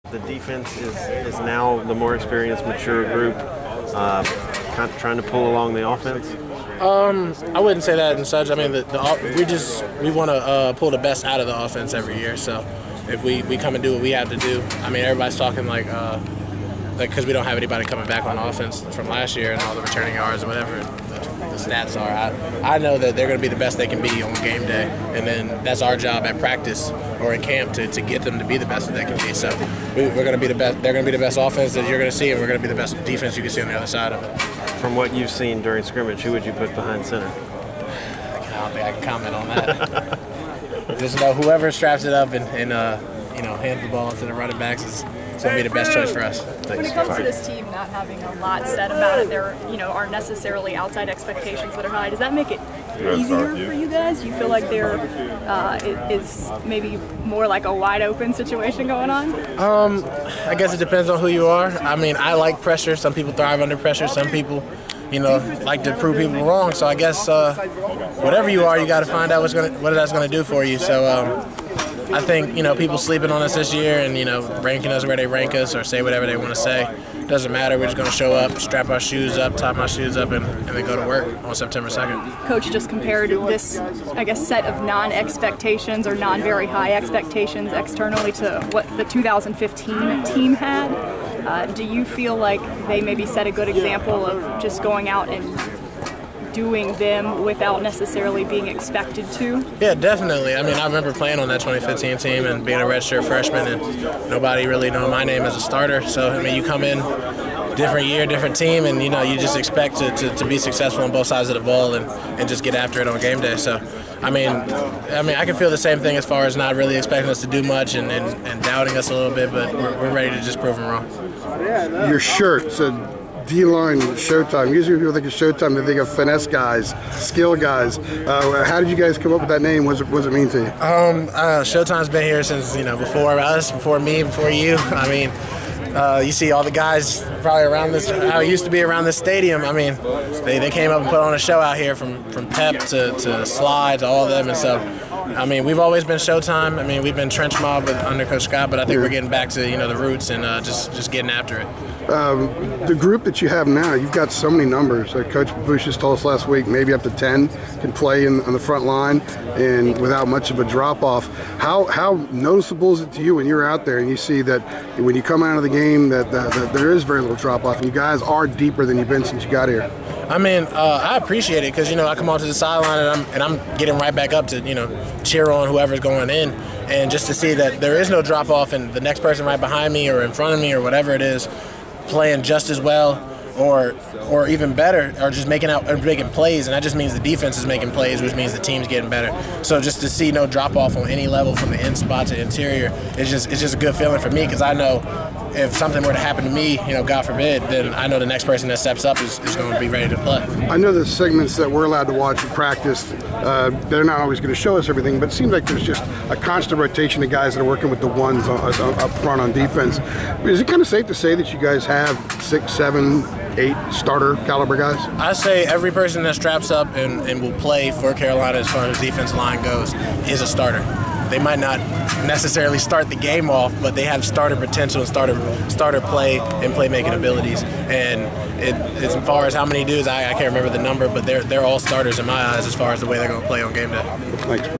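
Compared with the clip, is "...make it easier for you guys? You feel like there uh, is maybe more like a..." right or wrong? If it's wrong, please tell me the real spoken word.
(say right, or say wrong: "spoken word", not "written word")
right.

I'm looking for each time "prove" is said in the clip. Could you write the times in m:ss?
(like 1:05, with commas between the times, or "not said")
1:05, 2:00.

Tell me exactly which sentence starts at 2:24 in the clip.
And so, I mean, we've always been Showtime.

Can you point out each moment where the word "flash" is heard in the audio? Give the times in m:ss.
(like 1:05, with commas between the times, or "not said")
not said.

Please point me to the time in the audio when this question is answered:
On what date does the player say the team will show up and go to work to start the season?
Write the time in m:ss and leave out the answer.
1:21.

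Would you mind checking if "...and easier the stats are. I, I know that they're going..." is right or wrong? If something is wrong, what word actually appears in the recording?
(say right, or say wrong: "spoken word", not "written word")
wrong: "whatever", not "easier".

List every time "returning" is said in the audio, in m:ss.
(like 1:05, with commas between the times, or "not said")
0:19.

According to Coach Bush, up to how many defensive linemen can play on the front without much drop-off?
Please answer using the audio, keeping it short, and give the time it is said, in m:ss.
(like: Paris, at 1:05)
10, at 2:37.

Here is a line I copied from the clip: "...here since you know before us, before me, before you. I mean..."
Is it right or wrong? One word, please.
right.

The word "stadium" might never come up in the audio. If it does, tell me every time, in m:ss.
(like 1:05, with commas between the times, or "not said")
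2:19.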